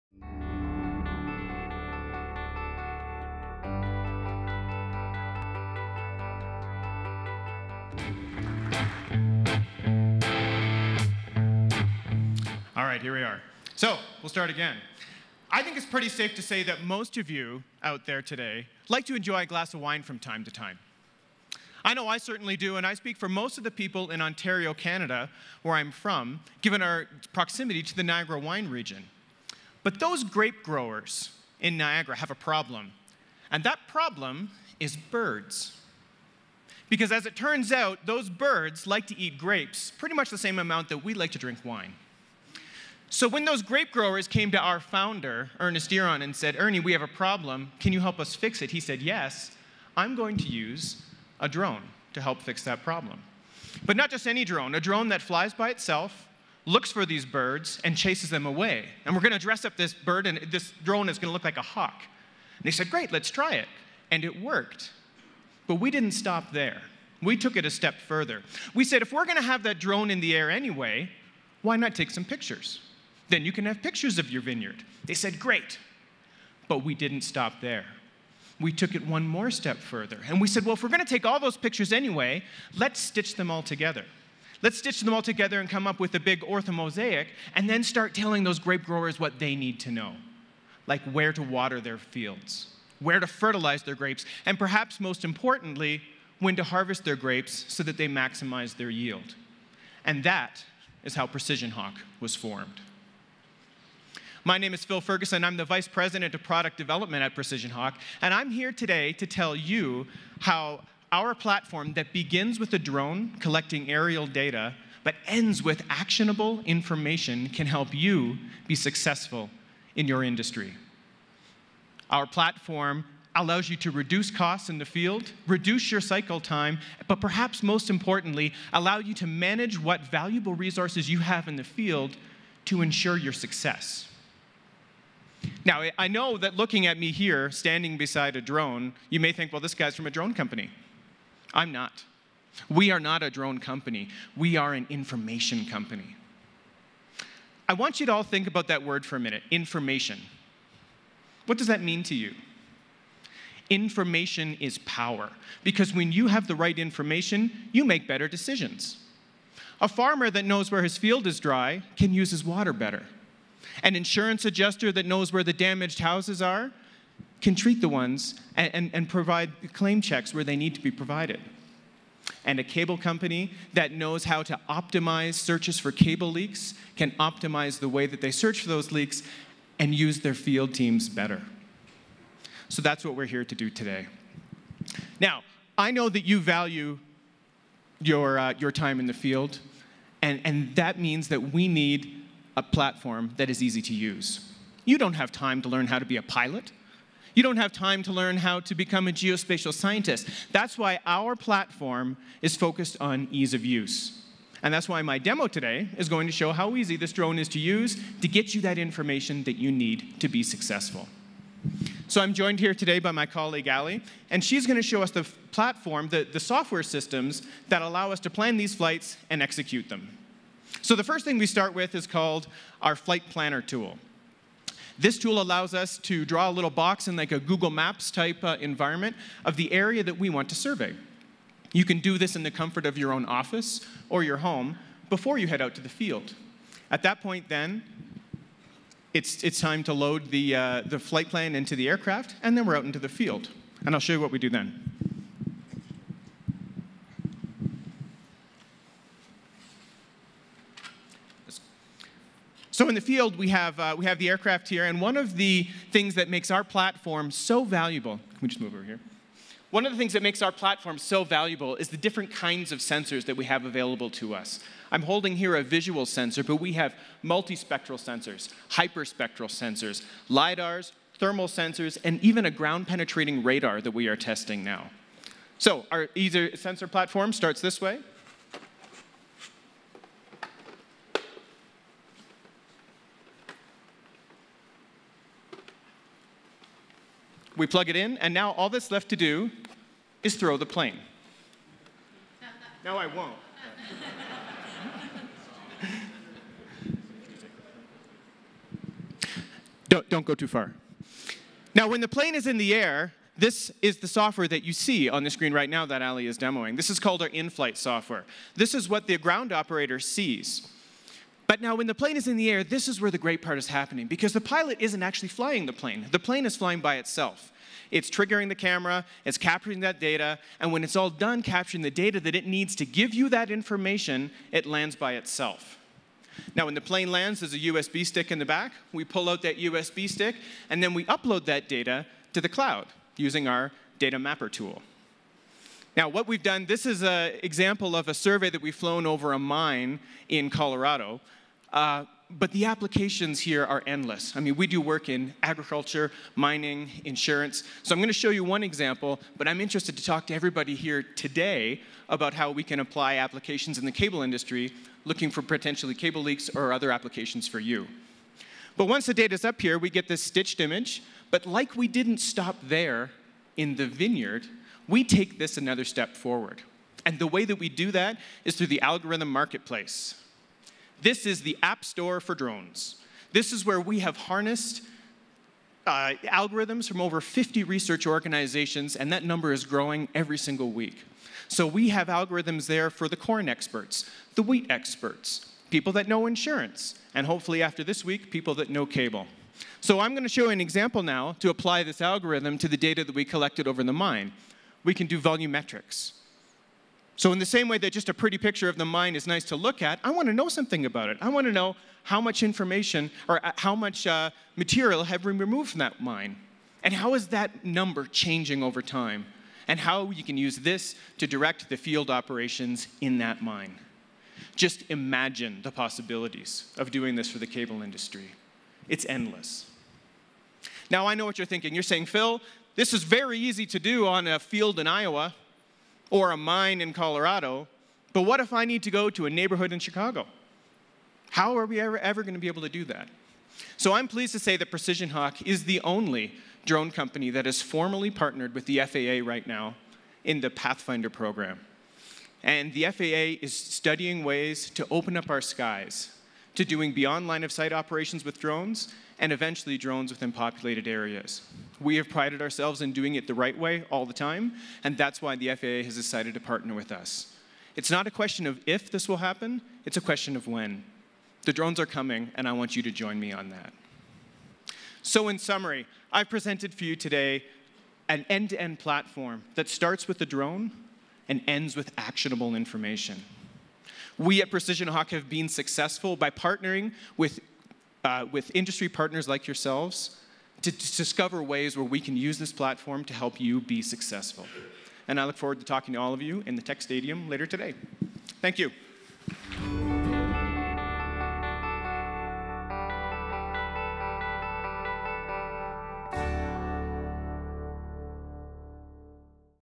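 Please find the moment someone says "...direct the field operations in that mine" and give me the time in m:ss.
6:51.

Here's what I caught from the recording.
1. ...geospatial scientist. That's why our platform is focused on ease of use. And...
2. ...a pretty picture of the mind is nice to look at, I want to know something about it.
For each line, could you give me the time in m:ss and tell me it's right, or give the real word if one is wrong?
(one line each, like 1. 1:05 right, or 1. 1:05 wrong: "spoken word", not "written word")
1. 3:19 right
2. 6:38 right.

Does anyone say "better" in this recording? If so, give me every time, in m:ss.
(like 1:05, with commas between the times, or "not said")
2:38, 2:42, 3:01.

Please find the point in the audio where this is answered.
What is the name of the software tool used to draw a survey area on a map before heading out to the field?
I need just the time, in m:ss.
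3:42.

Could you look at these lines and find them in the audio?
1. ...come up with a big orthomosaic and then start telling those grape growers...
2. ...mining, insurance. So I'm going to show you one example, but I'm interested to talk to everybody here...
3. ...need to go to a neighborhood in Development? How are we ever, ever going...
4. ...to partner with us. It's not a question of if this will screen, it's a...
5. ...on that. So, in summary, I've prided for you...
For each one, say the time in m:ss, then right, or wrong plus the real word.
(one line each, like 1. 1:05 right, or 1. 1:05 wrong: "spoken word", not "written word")
1. 1:25 right
2. 5:46 right
3. 7:08 wrong: "Chicago", not "Development"
4. 7:36 wrong: "happen", not "screen"
5. 7:43 wrong: "presented", not "prided".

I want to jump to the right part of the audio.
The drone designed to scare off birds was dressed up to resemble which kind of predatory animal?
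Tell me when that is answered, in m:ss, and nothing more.
1:01.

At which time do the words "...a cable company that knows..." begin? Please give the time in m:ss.
2:52.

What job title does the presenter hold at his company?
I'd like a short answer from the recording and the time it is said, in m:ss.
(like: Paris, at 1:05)
Vice President of Product Development, at 1:45.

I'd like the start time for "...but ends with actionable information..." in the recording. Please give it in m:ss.
1:55.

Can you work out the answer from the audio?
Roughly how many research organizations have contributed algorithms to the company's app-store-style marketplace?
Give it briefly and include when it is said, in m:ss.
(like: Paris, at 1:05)
Over 50, at 6:17.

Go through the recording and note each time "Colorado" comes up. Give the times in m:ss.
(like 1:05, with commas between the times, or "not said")
5:40, 7:06.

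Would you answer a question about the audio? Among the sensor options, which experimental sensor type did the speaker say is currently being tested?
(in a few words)
Ground penetrating radar.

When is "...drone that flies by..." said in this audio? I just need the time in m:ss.
0:54.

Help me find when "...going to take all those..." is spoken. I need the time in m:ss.
1:20.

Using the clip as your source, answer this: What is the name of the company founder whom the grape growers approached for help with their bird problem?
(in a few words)
Ernest Earon.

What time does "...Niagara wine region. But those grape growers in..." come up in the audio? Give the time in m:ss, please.
0:28.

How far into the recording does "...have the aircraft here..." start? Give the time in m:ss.
4:14.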